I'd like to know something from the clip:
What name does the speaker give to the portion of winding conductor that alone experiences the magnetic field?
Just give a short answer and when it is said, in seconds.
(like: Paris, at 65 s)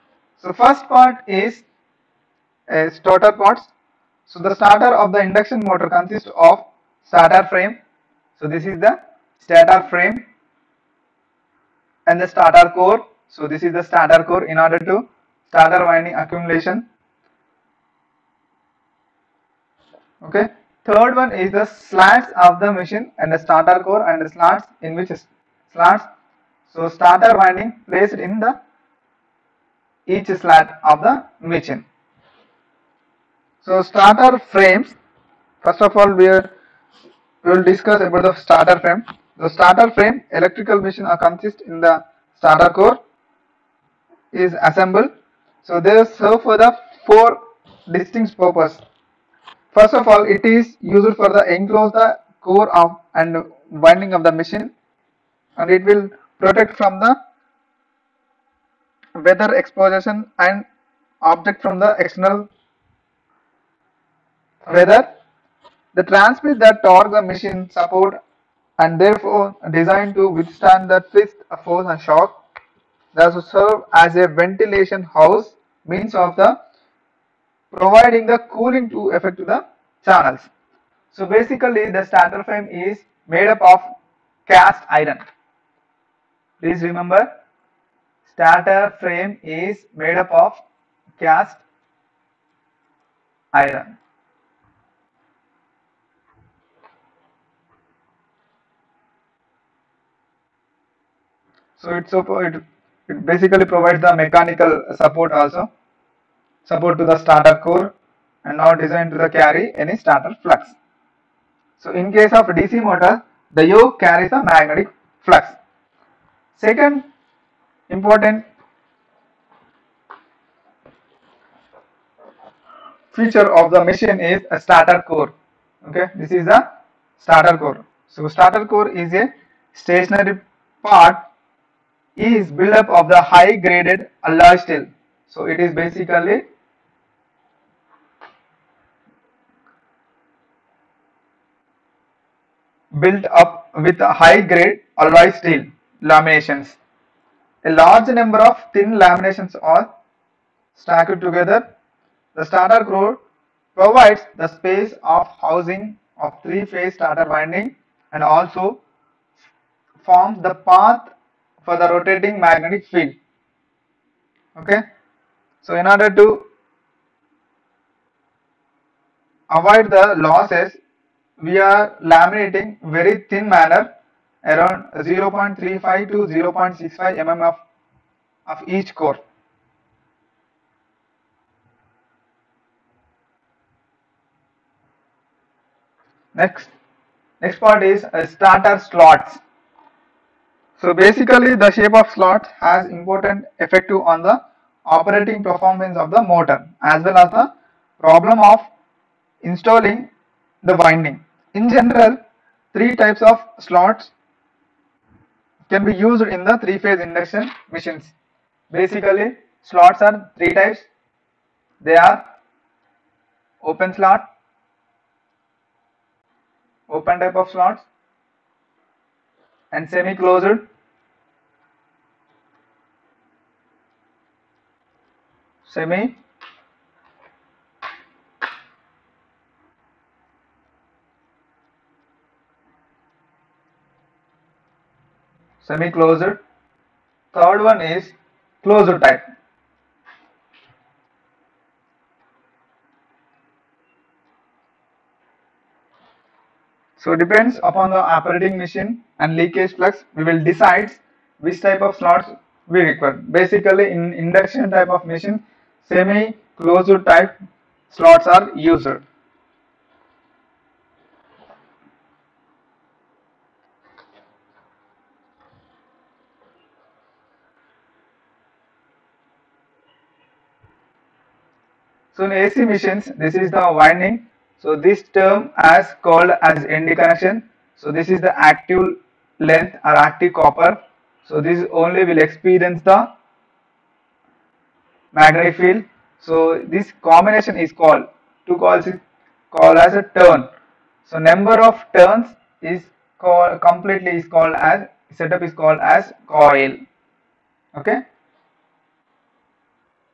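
active copper, at 279 s.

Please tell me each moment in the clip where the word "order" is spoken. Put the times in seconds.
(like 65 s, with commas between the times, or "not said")
14 s, 165 s.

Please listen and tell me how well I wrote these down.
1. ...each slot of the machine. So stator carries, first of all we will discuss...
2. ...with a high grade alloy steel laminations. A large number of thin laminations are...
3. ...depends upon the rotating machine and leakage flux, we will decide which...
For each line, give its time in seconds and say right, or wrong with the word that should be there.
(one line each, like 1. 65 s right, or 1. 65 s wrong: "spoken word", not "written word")
1. 30 s wrong: "frames", not "carries"
2. 143 s right
3. 247 s wrong: "operating", not "rotating".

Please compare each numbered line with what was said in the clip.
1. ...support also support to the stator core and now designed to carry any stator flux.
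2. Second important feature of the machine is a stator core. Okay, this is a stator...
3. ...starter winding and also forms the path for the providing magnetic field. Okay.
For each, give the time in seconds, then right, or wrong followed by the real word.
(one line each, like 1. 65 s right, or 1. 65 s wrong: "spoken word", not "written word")
1. 104 s right
2. 116 s right
3. 156 s wrong: "rotating", not "providing".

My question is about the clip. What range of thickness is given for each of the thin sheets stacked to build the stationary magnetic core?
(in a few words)
0.35 to 0.65 mm.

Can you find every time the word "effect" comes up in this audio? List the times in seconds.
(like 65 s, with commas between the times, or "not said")
79 s, 193 s.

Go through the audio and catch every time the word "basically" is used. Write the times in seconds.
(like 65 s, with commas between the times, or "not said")
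81 s, 103 s, 135 s, 190 s, 208 s, 253 s.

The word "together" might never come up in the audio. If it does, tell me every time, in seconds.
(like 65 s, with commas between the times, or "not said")
151 s.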